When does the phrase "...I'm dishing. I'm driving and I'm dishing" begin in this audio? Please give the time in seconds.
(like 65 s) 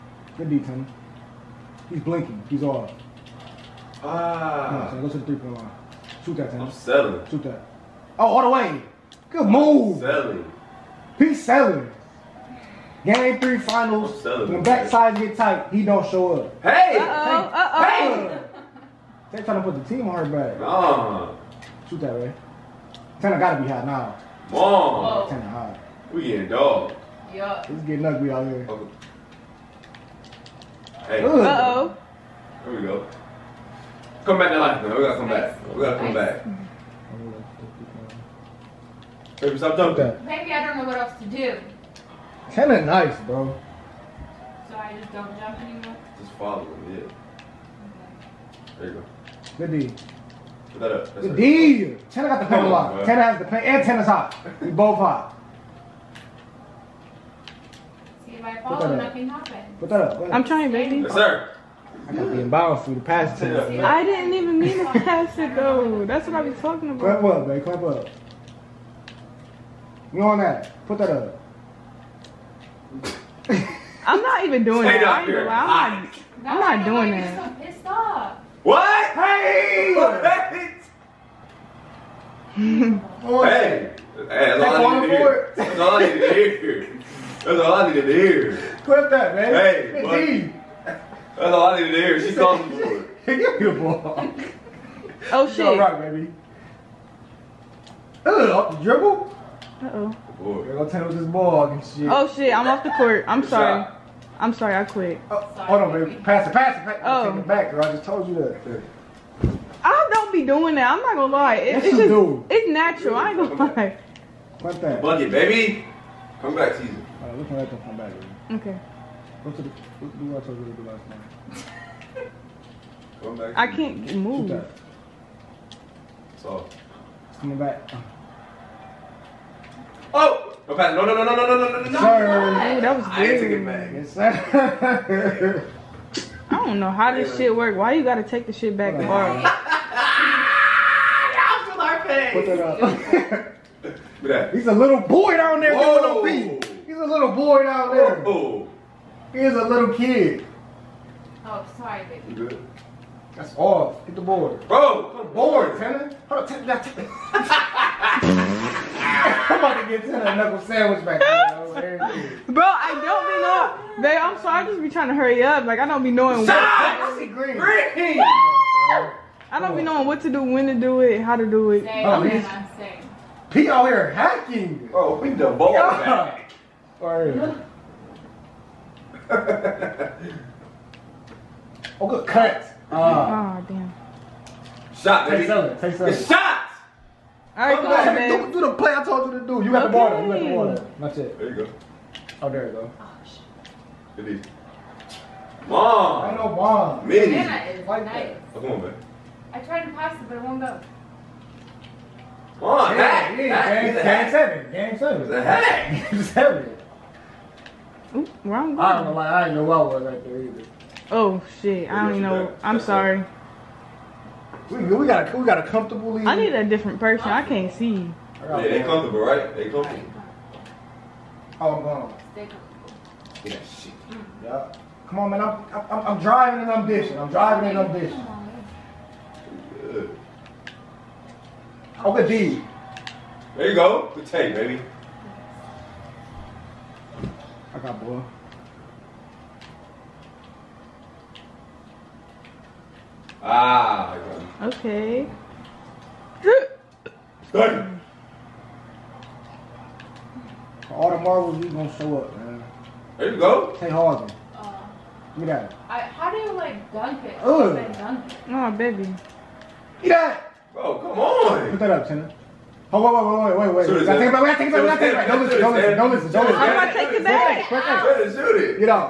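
226 s.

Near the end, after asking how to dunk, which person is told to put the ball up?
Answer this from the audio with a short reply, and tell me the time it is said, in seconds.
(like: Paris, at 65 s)
Tina, at 262 s.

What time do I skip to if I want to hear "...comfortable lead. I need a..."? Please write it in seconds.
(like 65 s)
215 s.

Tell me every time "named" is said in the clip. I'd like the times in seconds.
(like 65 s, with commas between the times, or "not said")
not said.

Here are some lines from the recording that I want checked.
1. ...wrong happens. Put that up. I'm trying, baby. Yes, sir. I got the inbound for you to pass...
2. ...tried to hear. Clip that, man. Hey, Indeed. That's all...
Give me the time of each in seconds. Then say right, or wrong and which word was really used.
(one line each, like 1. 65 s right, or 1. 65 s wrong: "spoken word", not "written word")
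1. 58 s wrong: "nothing", not "wrong"
2. 87 s wrong: "needed", not "tried".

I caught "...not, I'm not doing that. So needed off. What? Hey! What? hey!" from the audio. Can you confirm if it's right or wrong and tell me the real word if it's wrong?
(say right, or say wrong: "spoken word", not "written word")
wrong: "pissed", not "needed".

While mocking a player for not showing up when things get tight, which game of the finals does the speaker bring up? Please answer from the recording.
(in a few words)
Game 3.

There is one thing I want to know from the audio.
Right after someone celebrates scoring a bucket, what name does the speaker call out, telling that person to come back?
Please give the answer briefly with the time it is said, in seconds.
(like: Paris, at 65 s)
Caesar, at 116 s.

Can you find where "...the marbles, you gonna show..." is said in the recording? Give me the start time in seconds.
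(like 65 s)
251 s.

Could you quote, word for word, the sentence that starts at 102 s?
Oh shit, I'm off the court.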